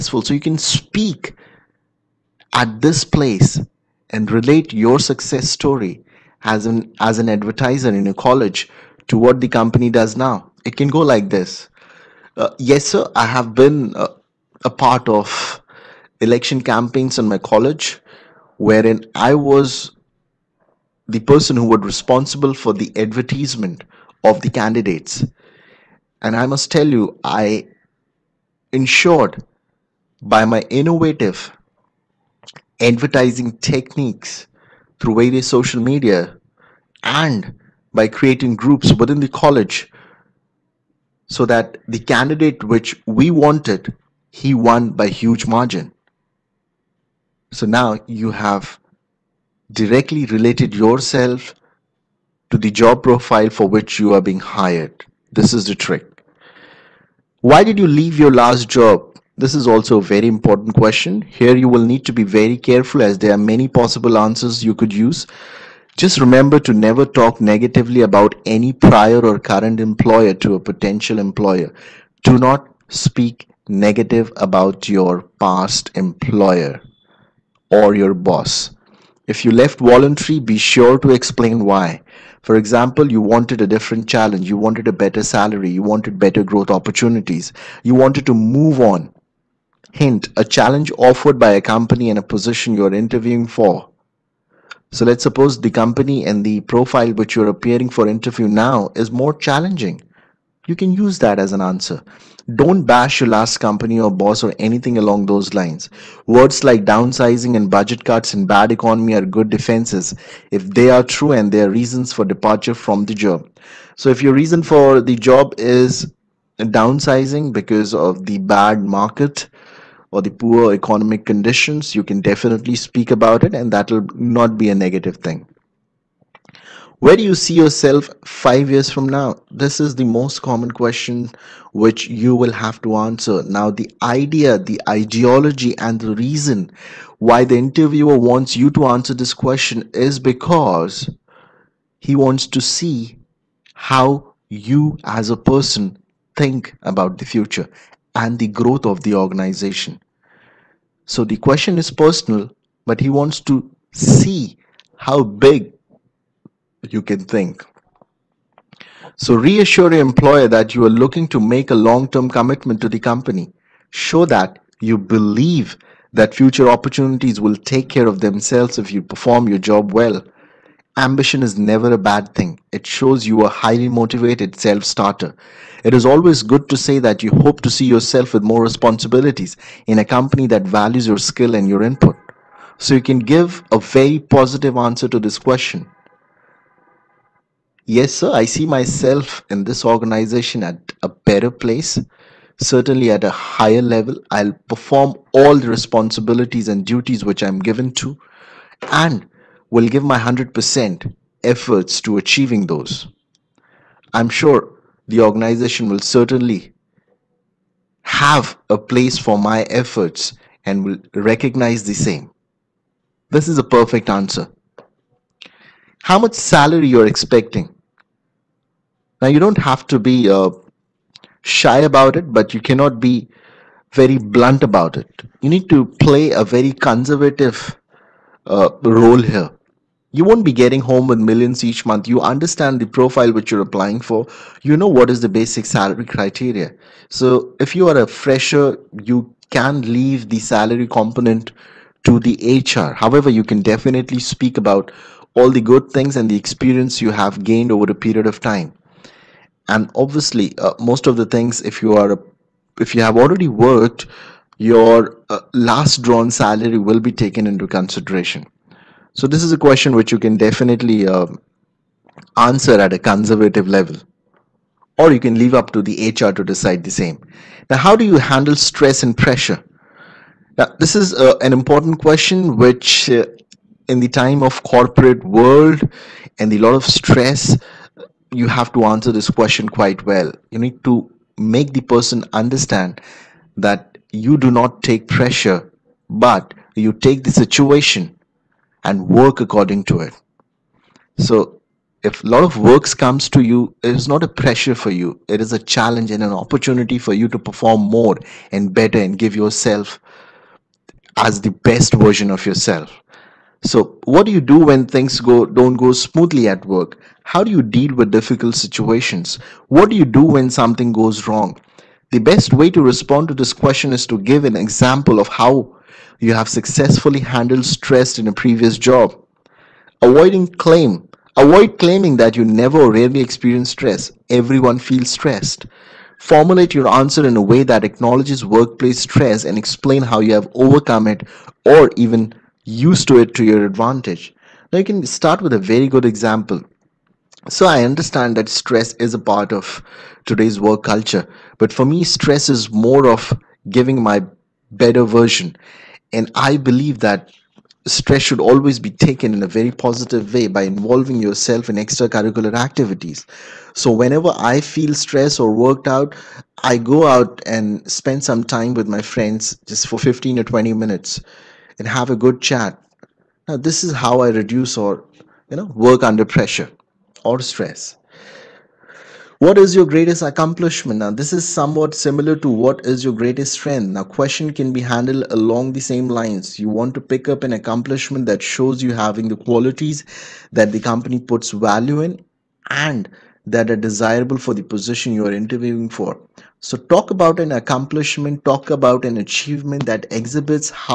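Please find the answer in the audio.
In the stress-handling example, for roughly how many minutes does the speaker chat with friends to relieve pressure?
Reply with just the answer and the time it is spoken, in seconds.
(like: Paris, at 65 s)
15 or 20 minutes, at 360 s.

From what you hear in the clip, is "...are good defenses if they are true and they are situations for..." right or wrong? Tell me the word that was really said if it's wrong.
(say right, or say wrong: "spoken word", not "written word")
wrong: "reasons", not "situations".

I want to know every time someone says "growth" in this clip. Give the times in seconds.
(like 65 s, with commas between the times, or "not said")
86 s, 148 s.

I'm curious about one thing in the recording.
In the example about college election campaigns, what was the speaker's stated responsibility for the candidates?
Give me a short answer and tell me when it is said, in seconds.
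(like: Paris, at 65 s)
Advertisement, at 22 s.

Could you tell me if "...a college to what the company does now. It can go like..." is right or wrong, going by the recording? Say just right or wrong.
right.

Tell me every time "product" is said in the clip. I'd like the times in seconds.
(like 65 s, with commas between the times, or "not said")
not said.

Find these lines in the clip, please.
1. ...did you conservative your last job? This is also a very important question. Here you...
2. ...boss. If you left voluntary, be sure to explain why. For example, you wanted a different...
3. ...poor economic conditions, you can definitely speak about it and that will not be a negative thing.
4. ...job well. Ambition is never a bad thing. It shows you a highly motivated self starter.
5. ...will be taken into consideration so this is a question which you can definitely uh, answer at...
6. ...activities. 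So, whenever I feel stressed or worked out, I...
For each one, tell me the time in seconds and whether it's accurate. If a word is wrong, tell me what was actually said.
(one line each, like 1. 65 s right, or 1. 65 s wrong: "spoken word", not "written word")
1. 57 s wrong: "leave", not "conservative"
2. 78 s right
3. 120 s right
4. 169 s right
5. 256 s right
6. 352 s right.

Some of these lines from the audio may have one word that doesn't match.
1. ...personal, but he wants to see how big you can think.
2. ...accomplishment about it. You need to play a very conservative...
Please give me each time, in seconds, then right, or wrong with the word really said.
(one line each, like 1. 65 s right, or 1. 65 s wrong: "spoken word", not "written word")
1. 151 s right
2. 224 s wrong: "blunt", not "accomplishment".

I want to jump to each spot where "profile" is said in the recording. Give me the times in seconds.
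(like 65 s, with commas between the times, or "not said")
53 s, 96 s, 232 s.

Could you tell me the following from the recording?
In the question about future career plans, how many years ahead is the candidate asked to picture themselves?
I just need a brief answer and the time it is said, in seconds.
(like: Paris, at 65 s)
5, at 128 s.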